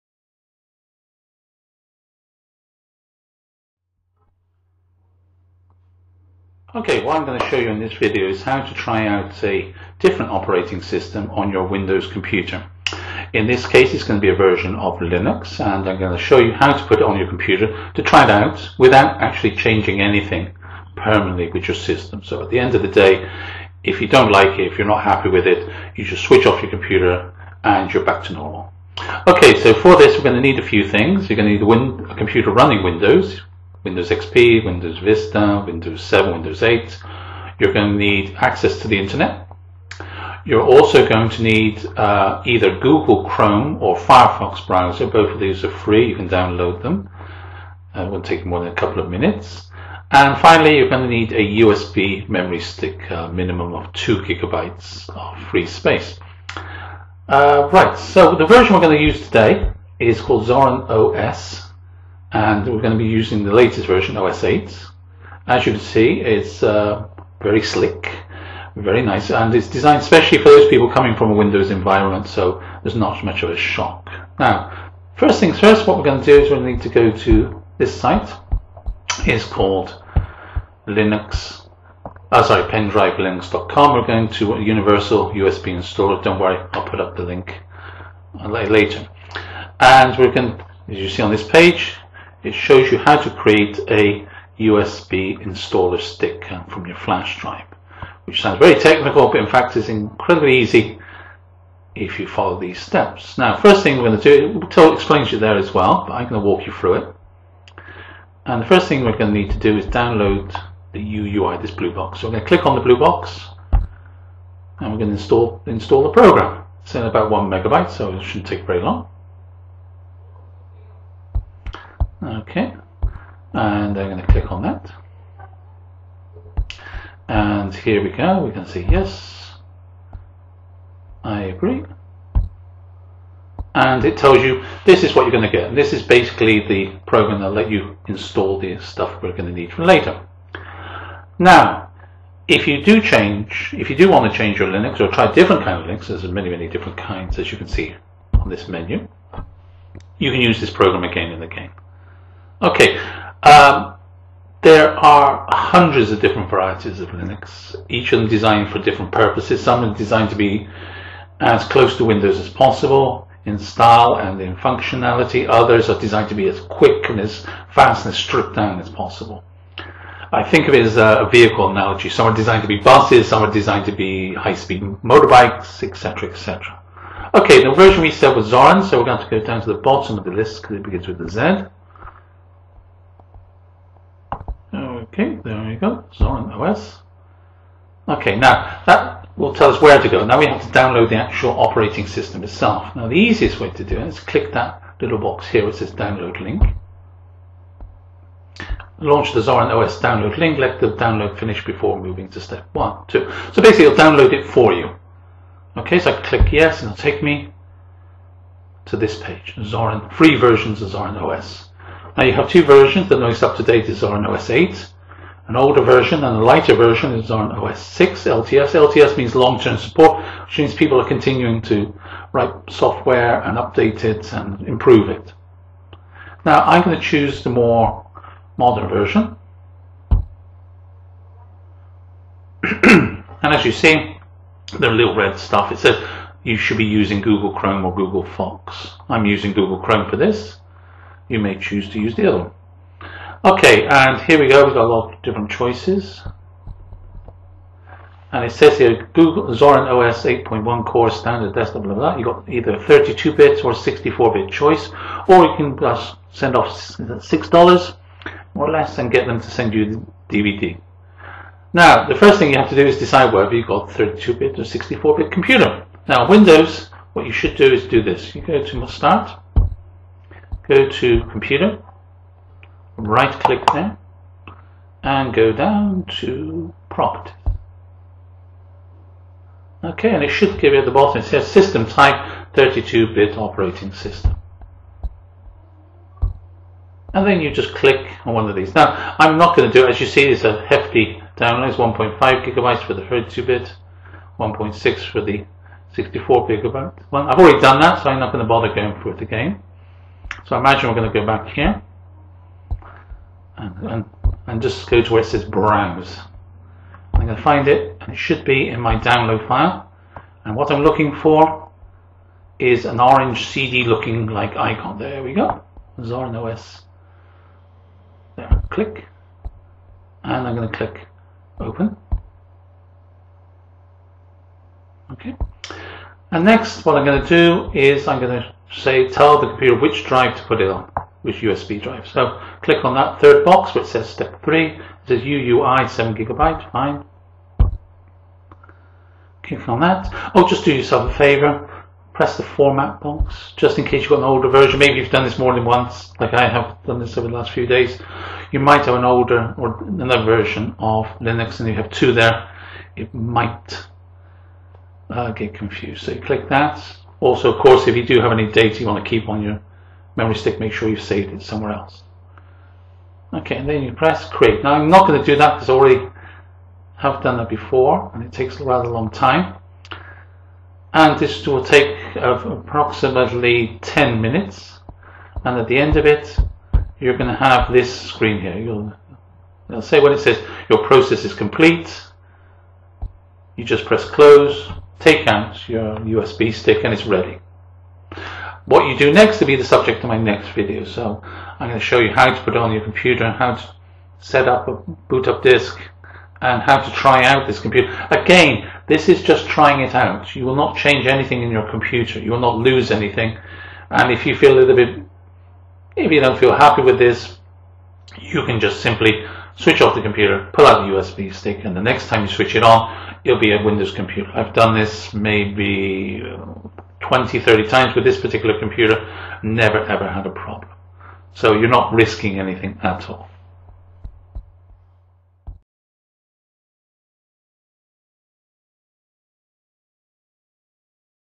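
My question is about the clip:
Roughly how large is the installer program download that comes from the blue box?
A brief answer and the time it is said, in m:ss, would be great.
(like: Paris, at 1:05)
1 megabyte, at 1:57.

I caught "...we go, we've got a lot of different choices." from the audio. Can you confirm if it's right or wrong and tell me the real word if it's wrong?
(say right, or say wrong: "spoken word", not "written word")
right.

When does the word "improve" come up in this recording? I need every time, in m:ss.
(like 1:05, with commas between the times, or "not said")
3:44.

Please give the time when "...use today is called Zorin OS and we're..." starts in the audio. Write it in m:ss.
0:59.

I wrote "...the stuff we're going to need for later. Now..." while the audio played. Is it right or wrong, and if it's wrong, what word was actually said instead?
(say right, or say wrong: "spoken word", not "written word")
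right.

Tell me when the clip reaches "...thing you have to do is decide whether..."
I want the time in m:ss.
4:22.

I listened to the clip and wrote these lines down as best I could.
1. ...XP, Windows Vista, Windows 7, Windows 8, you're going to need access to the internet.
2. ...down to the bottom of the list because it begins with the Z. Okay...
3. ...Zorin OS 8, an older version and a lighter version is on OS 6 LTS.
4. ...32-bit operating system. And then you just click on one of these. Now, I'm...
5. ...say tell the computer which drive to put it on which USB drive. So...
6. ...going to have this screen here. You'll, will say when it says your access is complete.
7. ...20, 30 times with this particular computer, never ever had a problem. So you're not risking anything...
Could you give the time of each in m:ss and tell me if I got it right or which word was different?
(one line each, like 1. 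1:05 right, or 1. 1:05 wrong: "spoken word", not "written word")
1. 0:34 right
2. 2:59 right
3. 3:34 right
4. 4:42 right
5. 5:28 right
6. 6:17 wrong: "process", not "access"
7. 6:57 right.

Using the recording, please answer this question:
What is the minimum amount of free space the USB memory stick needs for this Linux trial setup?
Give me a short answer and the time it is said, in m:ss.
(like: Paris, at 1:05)
2 gigabytes, at 0:53.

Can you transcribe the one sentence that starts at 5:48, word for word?
You might have an older or another version of Linux and you have two there.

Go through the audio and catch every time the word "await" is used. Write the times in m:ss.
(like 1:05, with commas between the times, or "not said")
not said.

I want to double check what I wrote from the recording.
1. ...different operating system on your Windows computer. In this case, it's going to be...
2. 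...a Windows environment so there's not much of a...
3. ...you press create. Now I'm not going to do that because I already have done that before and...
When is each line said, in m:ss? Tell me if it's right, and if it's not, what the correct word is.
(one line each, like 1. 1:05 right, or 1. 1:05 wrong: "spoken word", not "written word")
1. 0:09 right
2. 1:11 right
3. 6:03 right.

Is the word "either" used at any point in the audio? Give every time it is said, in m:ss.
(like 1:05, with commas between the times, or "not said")
0:42, 4:12.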